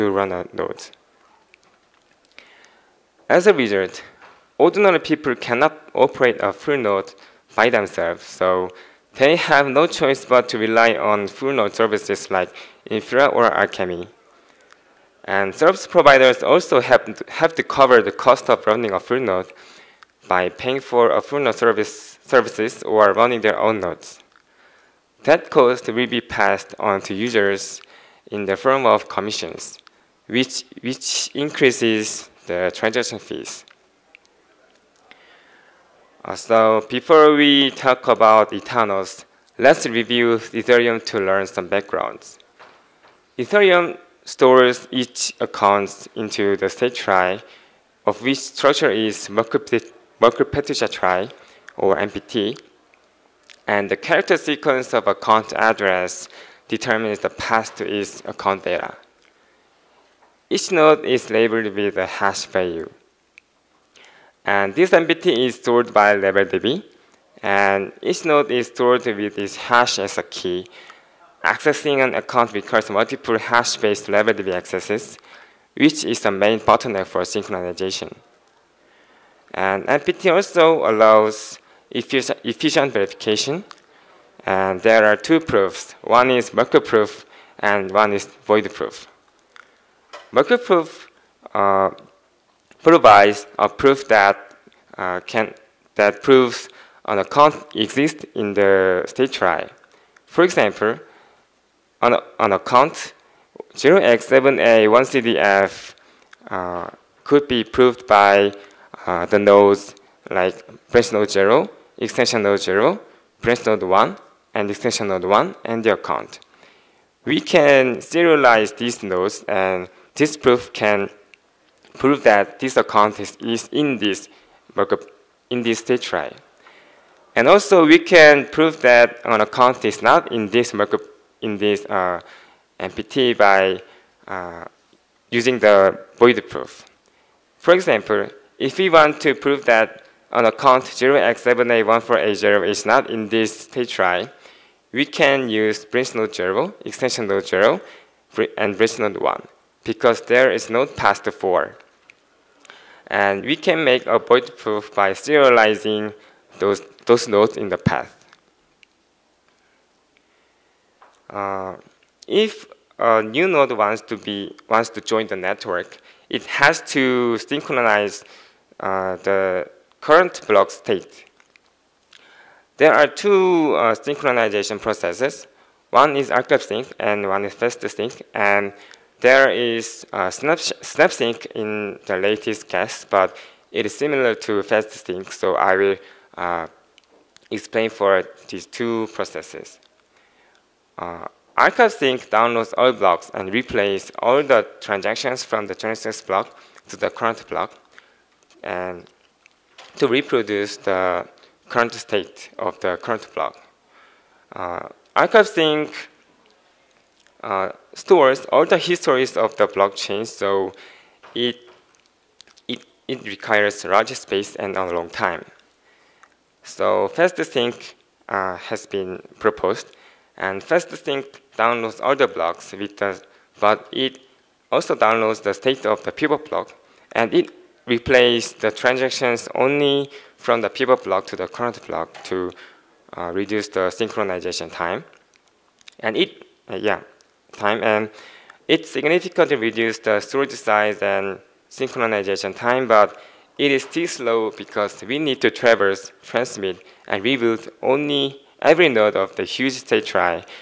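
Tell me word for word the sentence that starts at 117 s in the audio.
We can serialize these nodes, and this proof can prove that this account is in this in this state trie.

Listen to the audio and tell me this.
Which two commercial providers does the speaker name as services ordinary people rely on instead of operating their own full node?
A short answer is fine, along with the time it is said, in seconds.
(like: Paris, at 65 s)
Infura or Alchemy, at 12 s.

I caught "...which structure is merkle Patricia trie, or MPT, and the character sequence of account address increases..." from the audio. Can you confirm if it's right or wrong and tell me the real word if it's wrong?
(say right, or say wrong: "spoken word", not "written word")
wrong: "determines", not "increases".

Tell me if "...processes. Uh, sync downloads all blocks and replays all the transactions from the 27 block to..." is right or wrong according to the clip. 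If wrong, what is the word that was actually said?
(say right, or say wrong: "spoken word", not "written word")
wrong: "26", not "27".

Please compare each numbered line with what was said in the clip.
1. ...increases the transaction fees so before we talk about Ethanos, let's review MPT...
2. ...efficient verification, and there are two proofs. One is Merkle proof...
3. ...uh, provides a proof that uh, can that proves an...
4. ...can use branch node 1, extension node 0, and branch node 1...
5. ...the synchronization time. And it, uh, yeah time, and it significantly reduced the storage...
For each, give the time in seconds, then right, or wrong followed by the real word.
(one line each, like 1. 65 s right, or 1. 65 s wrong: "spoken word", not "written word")
1. 31 s wrong: "Ethereum", not "MPT"
2. 81 s right
3. 91 s right
4. 145 s wrong: "0", not "1"
5. 233 s right.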